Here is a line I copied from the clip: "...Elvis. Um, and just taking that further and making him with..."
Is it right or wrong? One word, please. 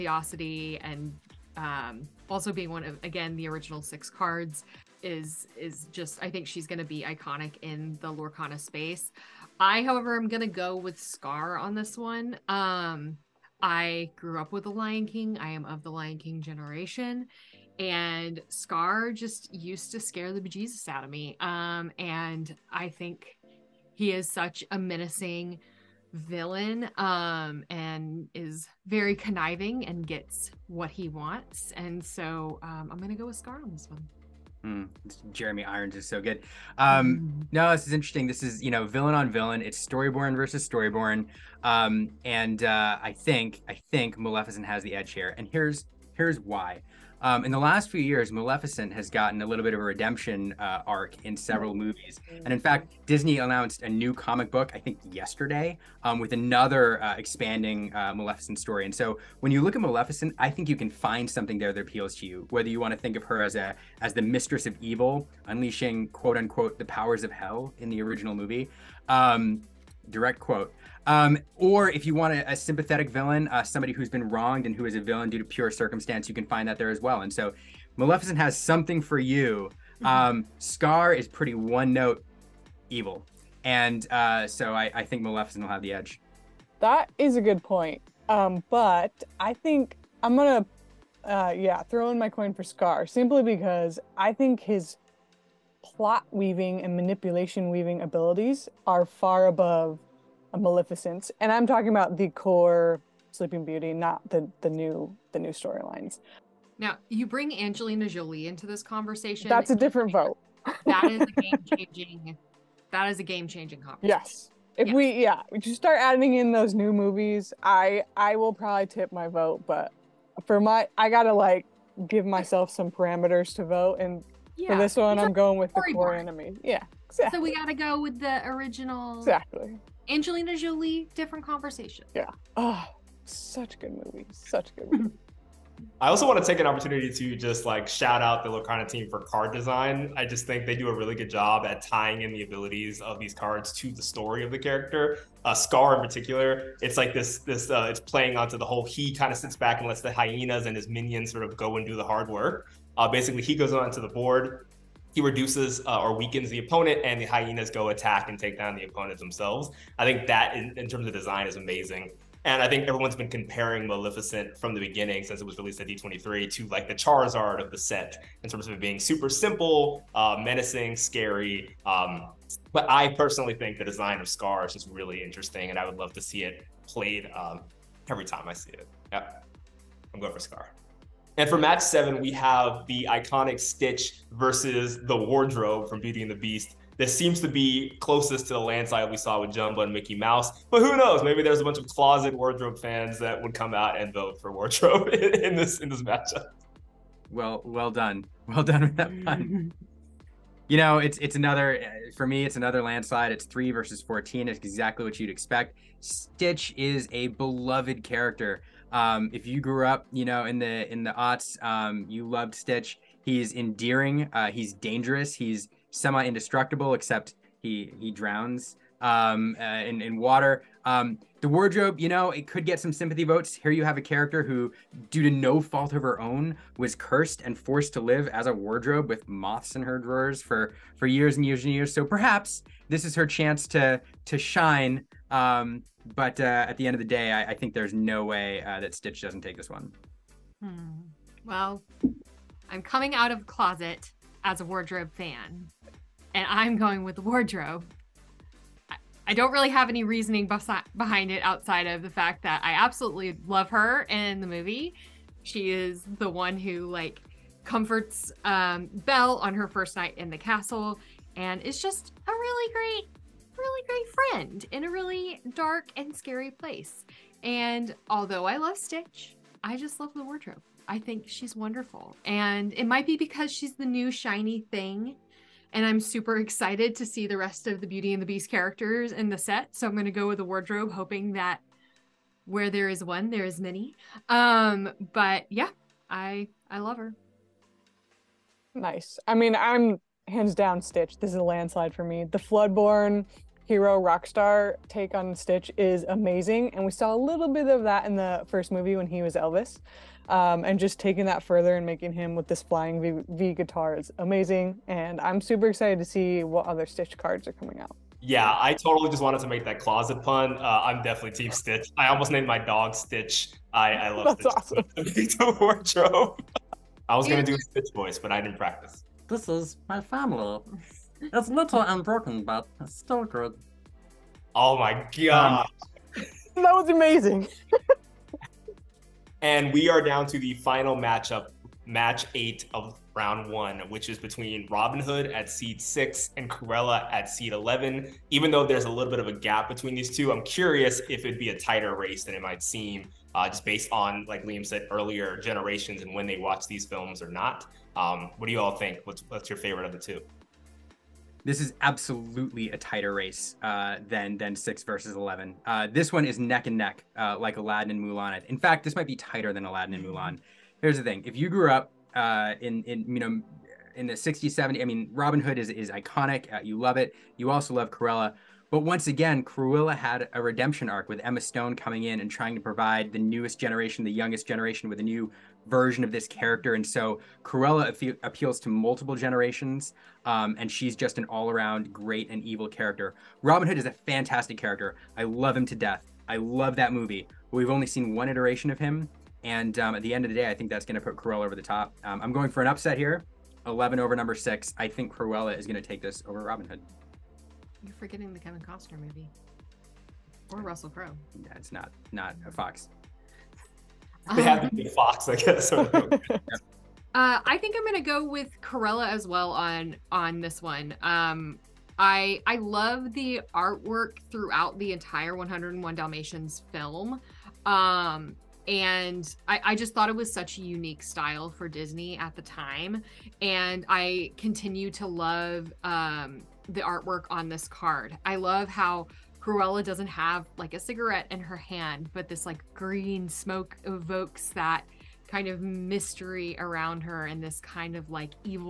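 right.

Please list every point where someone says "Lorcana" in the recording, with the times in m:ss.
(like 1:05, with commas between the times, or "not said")
0:08, 2:18.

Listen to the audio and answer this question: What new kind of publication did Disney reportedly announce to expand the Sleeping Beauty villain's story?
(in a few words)
comic book.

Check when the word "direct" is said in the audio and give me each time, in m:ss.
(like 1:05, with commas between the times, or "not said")
1:10.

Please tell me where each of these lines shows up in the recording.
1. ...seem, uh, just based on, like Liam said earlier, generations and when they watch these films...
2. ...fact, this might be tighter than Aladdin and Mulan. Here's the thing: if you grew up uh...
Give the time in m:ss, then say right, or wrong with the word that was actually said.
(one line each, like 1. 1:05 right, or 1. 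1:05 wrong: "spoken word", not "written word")
1. 5:42 right
2. 5:58 right.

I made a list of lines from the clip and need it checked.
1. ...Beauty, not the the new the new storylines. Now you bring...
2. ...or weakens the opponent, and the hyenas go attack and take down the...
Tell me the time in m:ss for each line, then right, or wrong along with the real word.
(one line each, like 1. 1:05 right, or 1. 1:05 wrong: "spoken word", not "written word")
1. 1:43 right
2. 2:35 right.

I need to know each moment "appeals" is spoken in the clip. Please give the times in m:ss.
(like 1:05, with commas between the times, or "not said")
1:01, 6:18.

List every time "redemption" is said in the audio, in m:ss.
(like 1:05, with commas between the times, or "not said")
0:49, 6:10.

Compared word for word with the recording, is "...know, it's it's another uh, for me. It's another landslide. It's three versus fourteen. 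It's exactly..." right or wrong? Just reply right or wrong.
right.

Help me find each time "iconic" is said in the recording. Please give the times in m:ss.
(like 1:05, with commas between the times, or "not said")
0:07, 3:03, 6:05.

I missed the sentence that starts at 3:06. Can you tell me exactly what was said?
This seems to be closest to the landslide we saw with Jumba and Mickey Mouse.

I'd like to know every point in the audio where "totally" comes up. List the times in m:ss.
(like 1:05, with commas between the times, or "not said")
5:08.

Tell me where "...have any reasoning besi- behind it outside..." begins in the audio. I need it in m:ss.
4:09.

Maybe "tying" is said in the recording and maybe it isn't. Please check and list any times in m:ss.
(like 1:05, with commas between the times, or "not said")
2:21.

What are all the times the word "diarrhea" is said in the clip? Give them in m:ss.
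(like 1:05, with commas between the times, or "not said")
not said.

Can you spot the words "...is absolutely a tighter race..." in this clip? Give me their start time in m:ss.
5:51.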